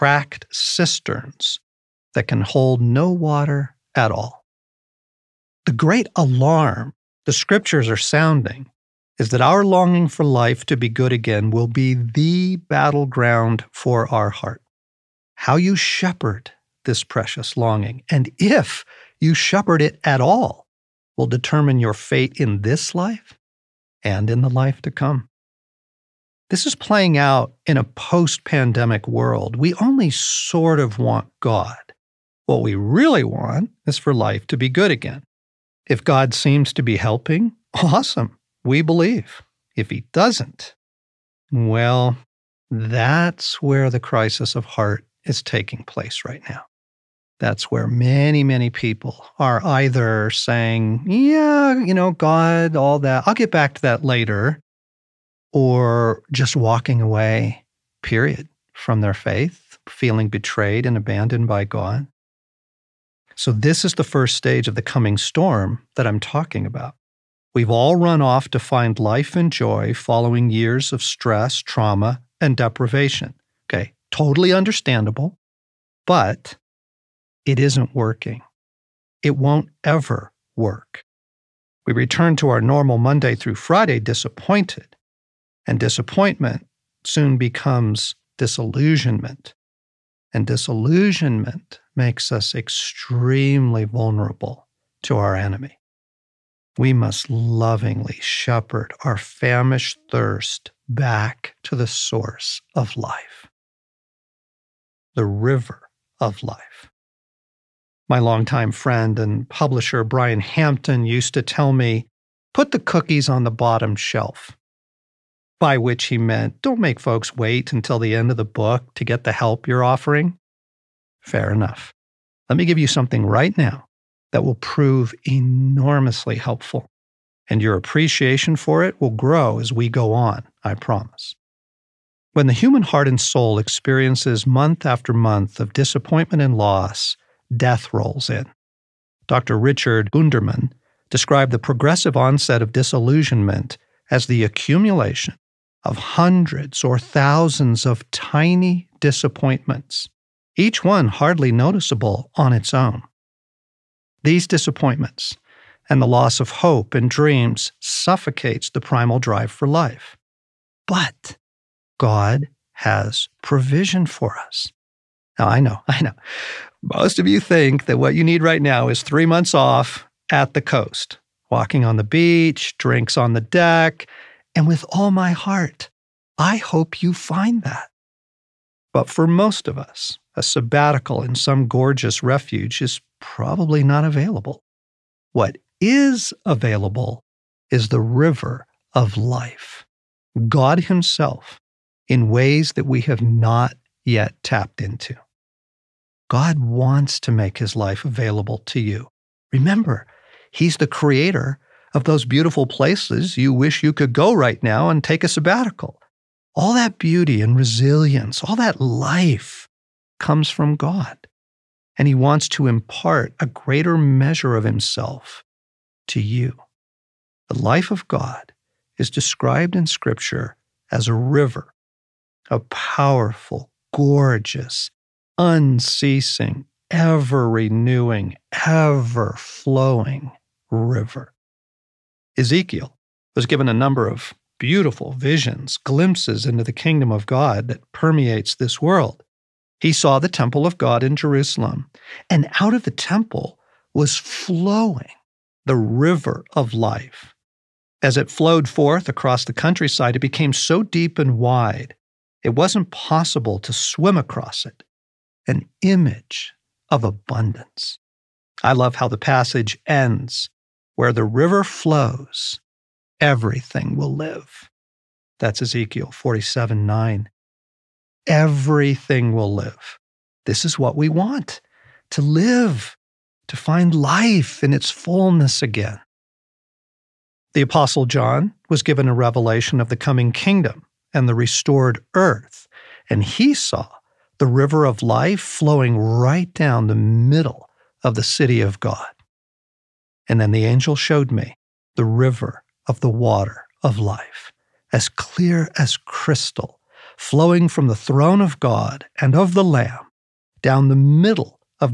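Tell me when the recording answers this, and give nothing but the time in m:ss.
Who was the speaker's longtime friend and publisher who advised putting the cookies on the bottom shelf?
1:50.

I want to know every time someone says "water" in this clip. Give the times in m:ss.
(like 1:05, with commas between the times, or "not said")
0:03, 4:53.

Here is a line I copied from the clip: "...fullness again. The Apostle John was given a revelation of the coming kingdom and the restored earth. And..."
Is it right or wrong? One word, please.
right.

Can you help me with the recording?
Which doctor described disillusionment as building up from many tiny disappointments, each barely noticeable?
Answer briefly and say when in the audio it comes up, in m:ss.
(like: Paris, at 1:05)
Richard Gunderman, at 2:19.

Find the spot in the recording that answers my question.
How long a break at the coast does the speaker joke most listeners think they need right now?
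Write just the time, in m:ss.
2:49.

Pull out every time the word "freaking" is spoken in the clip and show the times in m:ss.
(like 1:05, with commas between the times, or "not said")
not said.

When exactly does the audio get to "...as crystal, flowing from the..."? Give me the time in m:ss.
4:55.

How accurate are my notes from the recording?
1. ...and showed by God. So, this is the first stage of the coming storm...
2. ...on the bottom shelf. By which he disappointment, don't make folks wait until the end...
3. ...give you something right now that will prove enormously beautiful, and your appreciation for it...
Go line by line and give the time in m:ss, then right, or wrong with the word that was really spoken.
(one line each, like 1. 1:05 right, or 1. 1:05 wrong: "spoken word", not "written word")
1. 1:00 wrong: "abandoned", not "showed"
2. 1:53 wrong: "meant", not "disappointment"
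3. 2:02 wrong: "helpful", not "beautiful".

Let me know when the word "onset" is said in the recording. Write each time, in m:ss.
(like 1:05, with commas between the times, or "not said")
2:22.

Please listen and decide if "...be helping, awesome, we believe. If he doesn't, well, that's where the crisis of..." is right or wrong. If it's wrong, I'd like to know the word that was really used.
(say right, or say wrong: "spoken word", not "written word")
right.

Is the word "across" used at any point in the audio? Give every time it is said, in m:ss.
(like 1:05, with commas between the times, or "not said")
4:09, 4:14.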